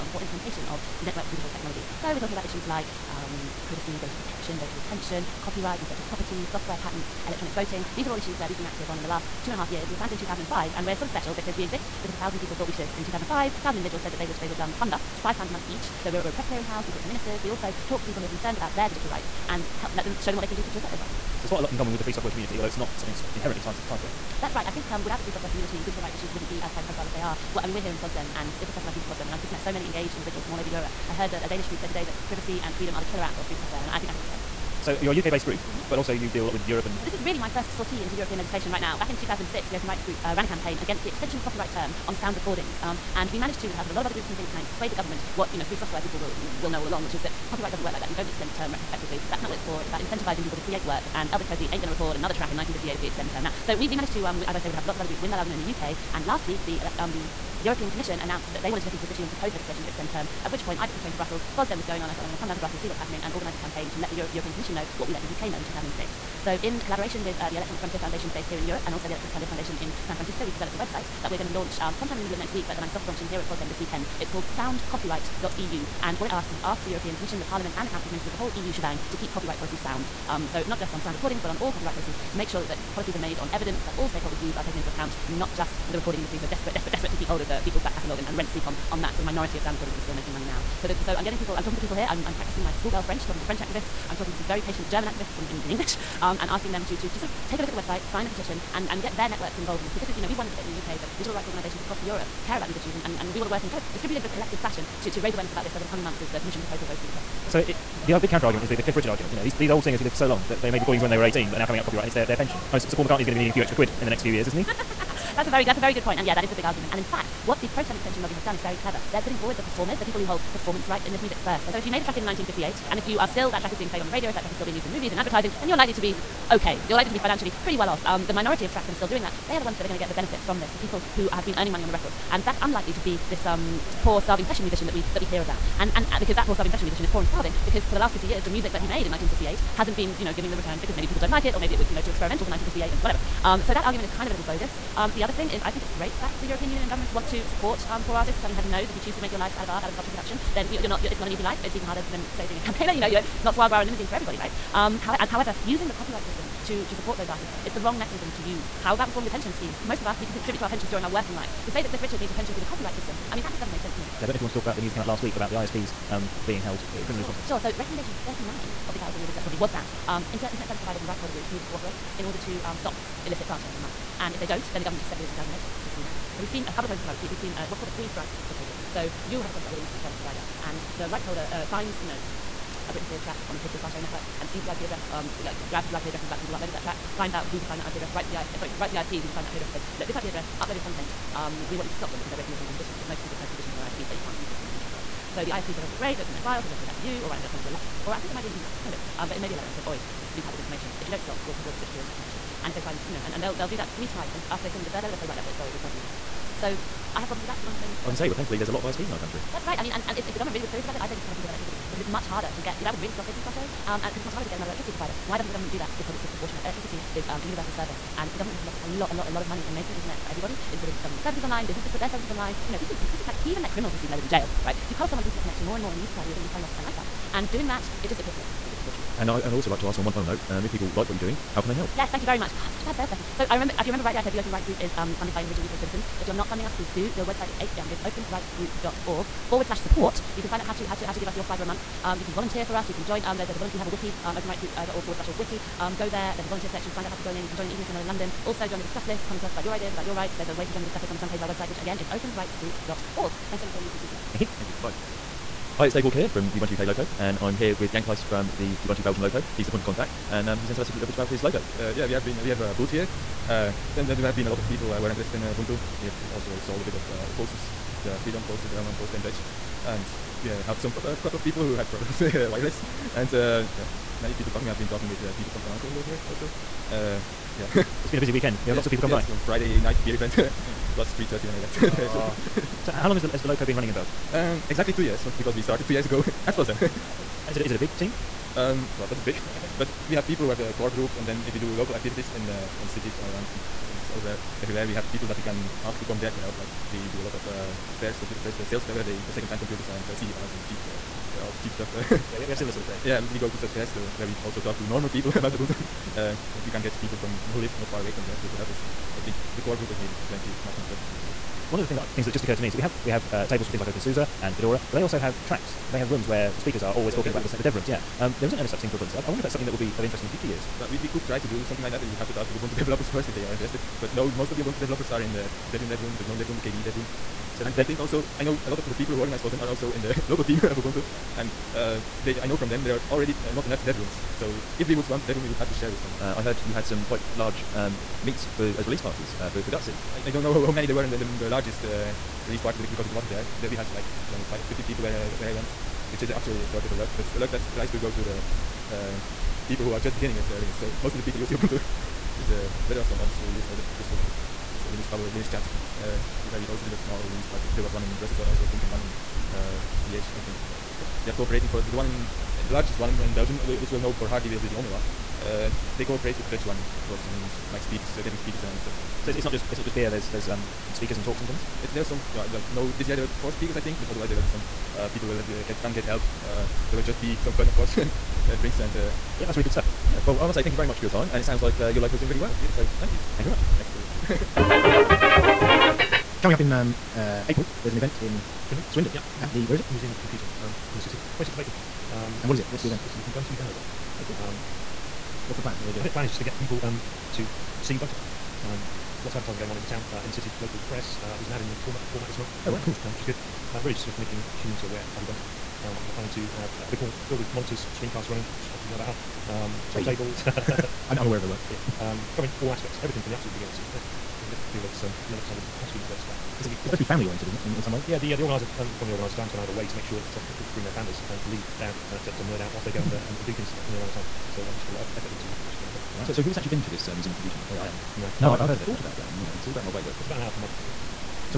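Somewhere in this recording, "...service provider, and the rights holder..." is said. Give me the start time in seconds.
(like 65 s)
180 s.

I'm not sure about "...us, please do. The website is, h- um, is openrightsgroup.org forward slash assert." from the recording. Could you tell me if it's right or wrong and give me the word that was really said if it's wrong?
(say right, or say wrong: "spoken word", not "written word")
wrong: "support", not "assert".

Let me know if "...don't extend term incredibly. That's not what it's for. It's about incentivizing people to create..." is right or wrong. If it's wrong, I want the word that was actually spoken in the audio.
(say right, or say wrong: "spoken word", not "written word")
wrong: "retrospectively", not "incredibly".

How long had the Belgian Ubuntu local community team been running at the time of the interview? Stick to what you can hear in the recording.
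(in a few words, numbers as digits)
exactly 2 years.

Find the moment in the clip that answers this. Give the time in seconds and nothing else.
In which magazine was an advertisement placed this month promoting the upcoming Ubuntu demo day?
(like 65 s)
401 s.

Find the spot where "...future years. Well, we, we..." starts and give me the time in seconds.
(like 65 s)
320 s.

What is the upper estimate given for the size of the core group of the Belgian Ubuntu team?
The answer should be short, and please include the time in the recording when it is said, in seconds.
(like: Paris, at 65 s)
30, at 310 s.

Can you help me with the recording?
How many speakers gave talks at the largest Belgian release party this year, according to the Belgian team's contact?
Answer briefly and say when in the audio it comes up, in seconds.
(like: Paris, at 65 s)
4, at 373 s.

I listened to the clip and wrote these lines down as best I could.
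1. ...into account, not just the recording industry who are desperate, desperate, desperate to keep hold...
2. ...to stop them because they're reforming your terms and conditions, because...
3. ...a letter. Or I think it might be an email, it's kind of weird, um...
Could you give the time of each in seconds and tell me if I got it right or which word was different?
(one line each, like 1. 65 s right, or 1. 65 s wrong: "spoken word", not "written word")
1. 84 s right
2. 191 s wrong: "breaking", not "reforming"
3. 197 s right.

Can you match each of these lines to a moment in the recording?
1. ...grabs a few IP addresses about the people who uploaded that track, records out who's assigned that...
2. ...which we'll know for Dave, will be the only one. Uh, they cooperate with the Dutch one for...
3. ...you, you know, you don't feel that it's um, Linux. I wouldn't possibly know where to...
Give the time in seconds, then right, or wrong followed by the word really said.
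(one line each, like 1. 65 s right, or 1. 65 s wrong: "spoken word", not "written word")
1. 185 s wrong: "finds", not "records"
2. 363 s wrong: "Hardy", not "Dave"
3. 414 s right.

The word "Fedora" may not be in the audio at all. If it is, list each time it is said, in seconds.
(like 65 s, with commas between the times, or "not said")
314 s.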